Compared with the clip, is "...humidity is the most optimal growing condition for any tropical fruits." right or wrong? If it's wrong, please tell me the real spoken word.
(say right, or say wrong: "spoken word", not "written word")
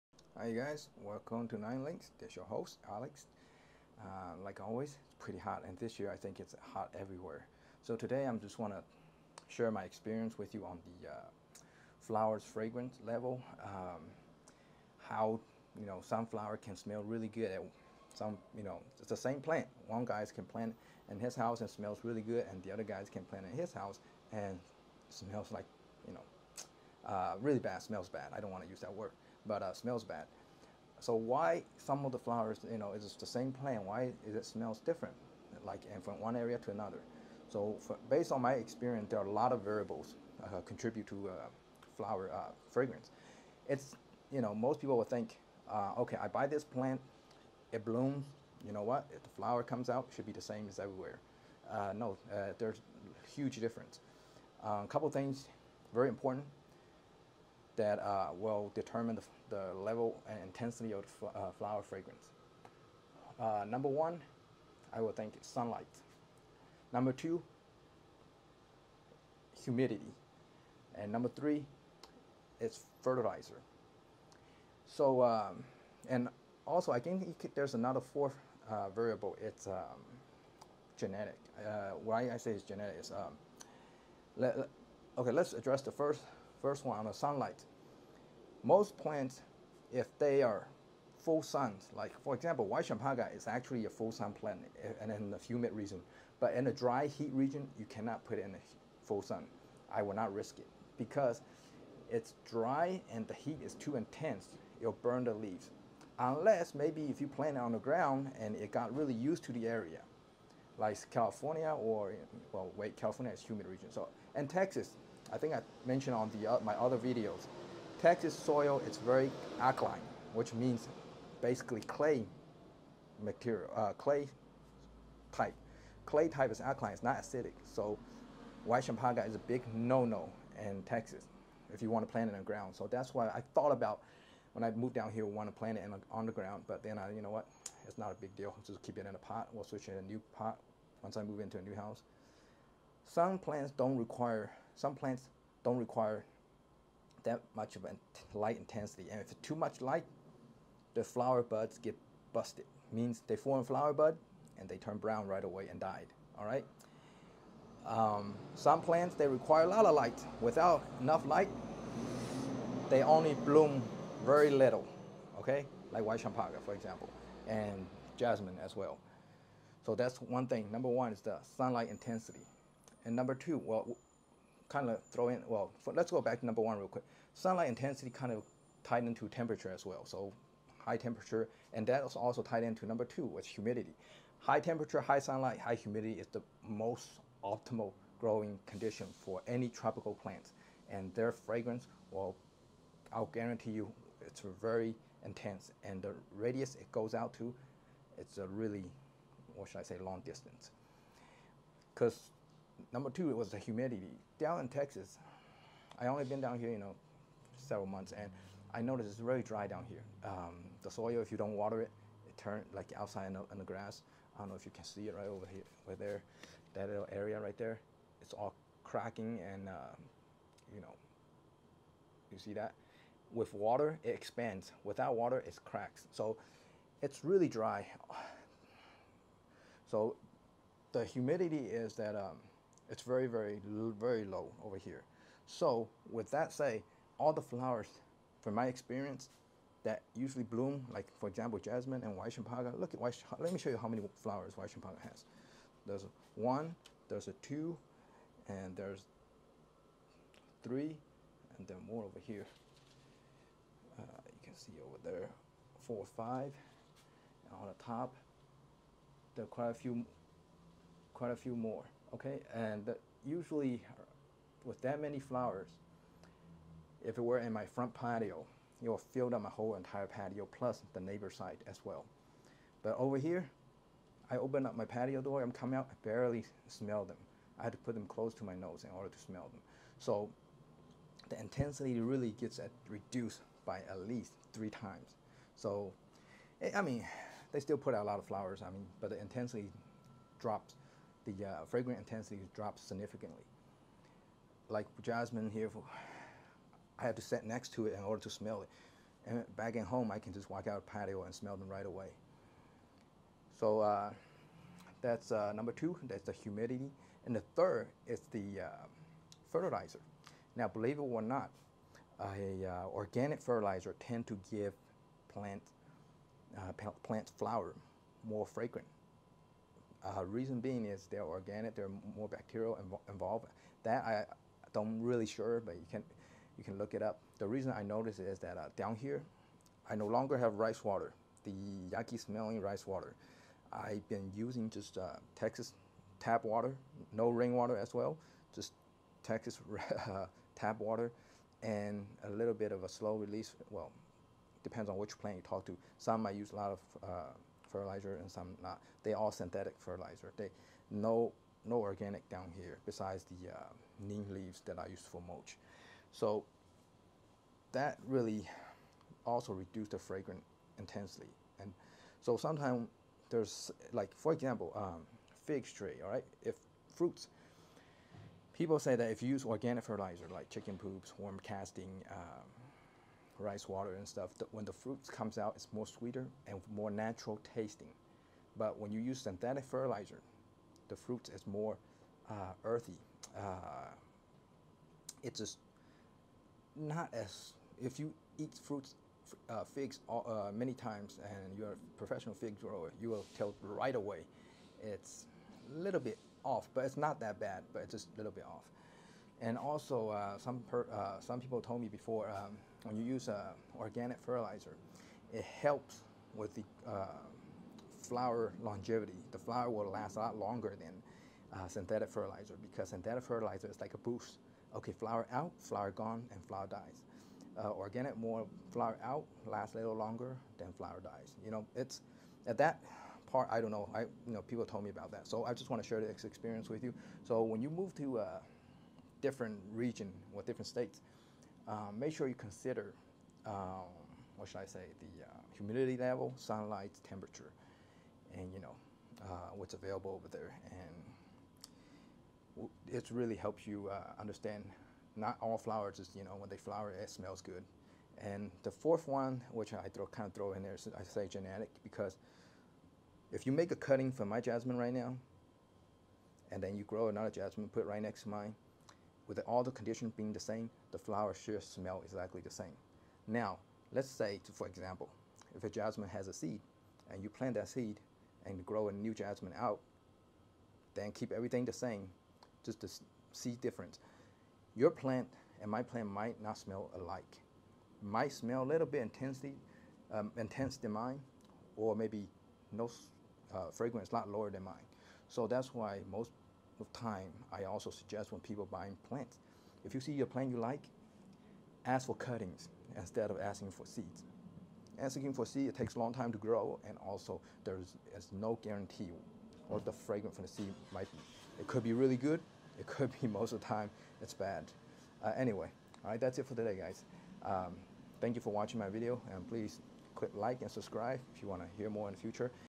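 wrong: "plants", not "fruits".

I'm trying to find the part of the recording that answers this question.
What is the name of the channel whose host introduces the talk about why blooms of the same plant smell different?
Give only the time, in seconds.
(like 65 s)
1 s.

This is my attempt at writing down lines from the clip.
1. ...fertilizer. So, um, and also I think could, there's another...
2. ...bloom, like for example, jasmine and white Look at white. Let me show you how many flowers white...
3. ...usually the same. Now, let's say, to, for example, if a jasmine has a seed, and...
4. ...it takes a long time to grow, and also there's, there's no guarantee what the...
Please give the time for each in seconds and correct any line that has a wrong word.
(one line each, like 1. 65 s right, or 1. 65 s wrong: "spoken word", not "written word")
1. 73 s right
2. 240 s right
3. 462 s wrong: "exactly", not "usually"
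4. 495 s right.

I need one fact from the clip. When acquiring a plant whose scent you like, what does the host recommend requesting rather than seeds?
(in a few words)
Cuttings.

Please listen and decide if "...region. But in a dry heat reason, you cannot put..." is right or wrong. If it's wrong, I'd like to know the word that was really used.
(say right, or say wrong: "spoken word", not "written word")
wrong: "region", not "reason".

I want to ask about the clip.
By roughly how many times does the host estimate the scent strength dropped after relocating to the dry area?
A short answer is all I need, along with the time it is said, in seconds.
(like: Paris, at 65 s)
3, at 284 s.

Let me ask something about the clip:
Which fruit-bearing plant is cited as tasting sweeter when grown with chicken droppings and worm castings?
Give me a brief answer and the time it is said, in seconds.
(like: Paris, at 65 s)
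Fig tree, at 365 s.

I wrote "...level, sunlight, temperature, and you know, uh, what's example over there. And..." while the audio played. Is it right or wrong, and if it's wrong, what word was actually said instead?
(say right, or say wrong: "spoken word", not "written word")
wrong: "available", not "example".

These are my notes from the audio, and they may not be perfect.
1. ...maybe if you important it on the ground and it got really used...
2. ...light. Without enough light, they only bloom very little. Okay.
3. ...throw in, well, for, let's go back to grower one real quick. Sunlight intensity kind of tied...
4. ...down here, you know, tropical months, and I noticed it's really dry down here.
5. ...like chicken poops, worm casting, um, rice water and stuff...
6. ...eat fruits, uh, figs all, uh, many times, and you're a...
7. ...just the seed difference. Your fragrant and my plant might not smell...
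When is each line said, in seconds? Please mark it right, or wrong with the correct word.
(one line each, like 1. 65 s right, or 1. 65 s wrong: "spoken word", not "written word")
1. 106 s wrong: "plant", not "important"
2. 159 s right
3. 175 s wrong: "number", not "grower"
4. 206 s wrong: "several", not "tropical"
5. 370 s right
6. 388 s right
7. 472 s wrong: "plant", not "fragrant".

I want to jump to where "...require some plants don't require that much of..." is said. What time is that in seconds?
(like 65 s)
143 s.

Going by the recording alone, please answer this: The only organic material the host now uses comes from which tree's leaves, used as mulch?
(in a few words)
Neem.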